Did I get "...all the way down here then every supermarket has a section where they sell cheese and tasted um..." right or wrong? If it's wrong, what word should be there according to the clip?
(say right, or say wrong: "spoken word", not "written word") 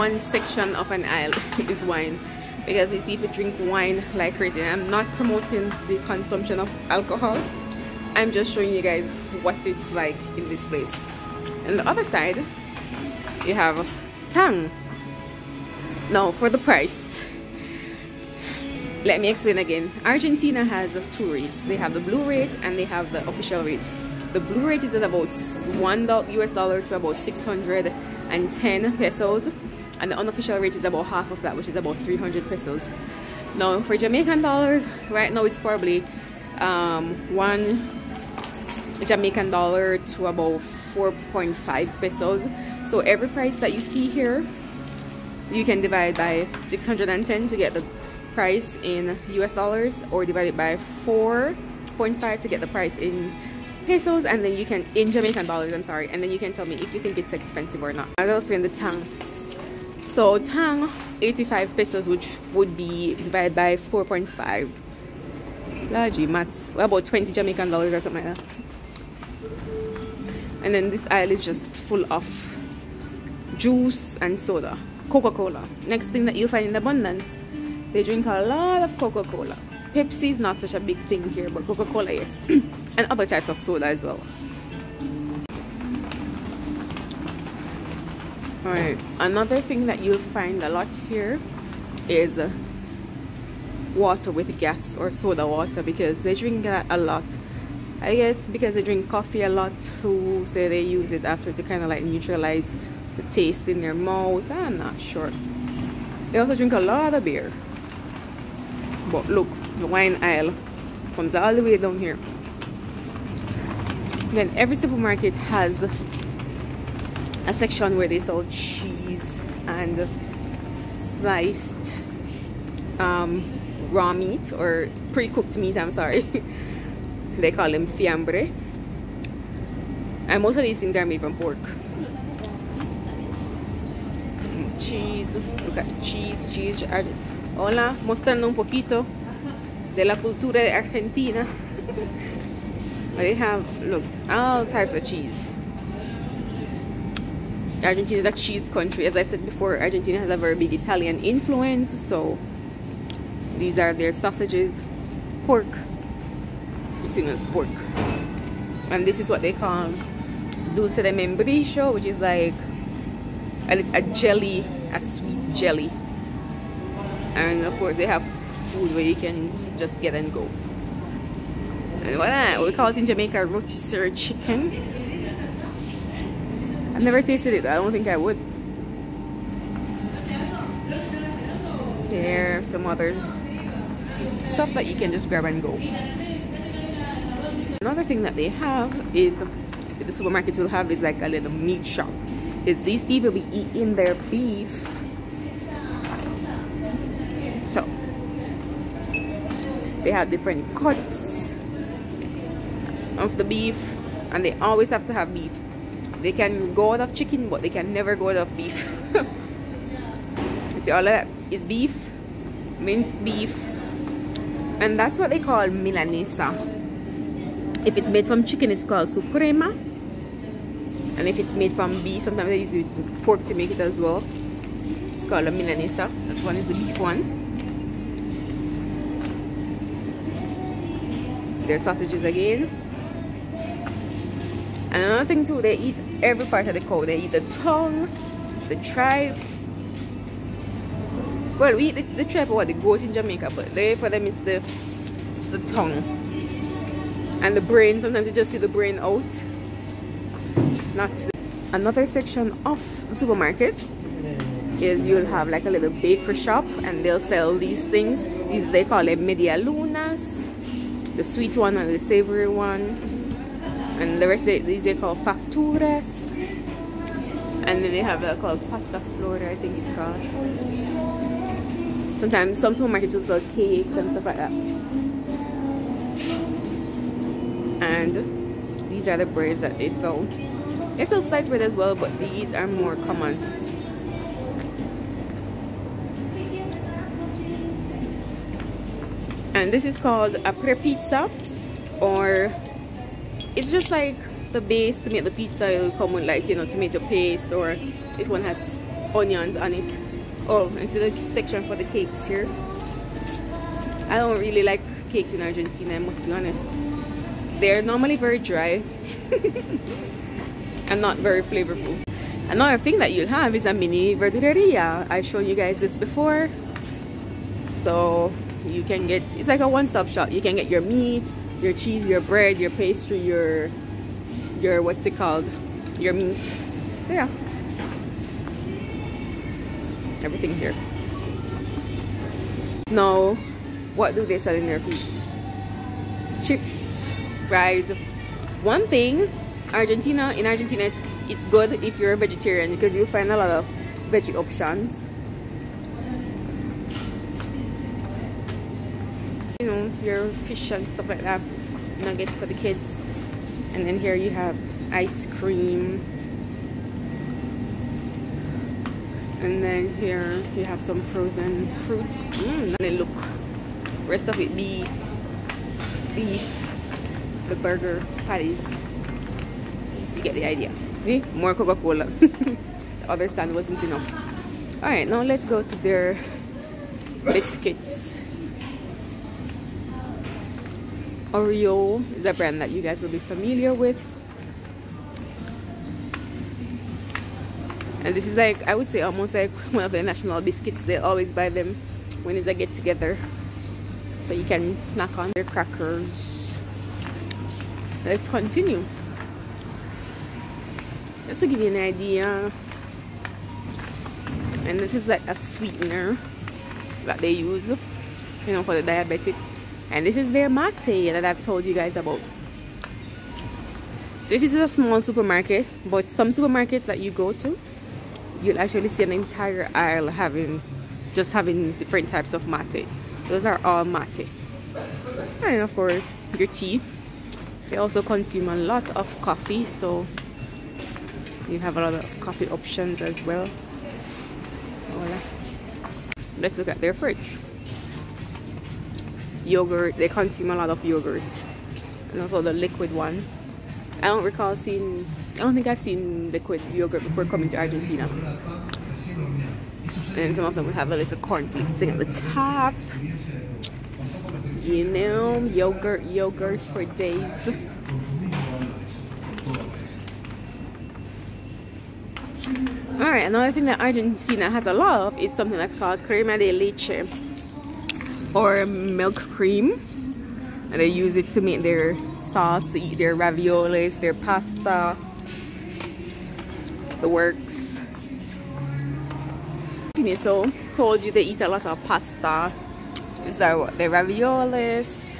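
wrong: "sliced", not "tasted".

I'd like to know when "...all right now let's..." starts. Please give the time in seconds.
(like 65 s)
374 s.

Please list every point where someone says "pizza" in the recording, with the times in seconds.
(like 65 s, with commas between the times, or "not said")
290 s, 295 s.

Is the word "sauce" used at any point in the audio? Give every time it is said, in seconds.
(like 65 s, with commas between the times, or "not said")
472 s.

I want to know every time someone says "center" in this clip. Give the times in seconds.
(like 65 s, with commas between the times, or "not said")
not said.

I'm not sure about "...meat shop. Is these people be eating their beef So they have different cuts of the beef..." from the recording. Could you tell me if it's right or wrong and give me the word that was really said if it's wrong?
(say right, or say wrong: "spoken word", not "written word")
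right.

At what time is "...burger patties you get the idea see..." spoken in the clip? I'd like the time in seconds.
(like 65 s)
367 s.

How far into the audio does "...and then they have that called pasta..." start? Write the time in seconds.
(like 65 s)
267 s.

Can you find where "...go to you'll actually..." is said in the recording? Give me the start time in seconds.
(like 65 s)
417 s.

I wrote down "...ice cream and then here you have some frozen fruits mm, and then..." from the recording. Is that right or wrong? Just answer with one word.
right.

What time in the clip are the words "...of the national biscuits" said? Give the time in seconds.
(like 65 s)
389 s.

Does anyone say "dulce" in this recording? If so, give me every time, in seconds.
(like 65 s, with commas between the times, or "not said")
160 s.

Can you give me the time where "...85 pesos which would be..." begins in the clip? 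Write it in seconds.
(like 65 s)
61 s.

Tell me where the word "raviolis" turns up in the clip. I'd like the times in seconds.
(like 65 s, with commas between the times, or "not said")
473 s, 483 s.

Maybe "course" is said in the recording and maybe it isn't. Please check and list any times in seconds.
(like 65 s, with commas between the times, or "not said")
167 s, 425 s.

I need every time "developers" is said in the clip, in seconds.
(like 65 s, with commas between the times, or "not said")
not said.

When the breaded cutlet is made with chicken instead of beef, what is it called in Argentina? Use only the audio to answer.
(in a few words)
suprema.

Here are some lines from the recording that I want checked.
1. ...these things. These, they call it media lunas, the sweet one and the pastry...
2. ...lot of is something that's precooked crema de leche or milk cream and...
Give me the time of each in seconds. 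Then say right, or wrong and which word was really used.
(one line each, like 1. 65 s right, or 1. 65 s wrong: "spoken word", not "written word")
1. 257 s wrong: "savory", not "pastry"
2. 464 s wrong: "called", not "precooked".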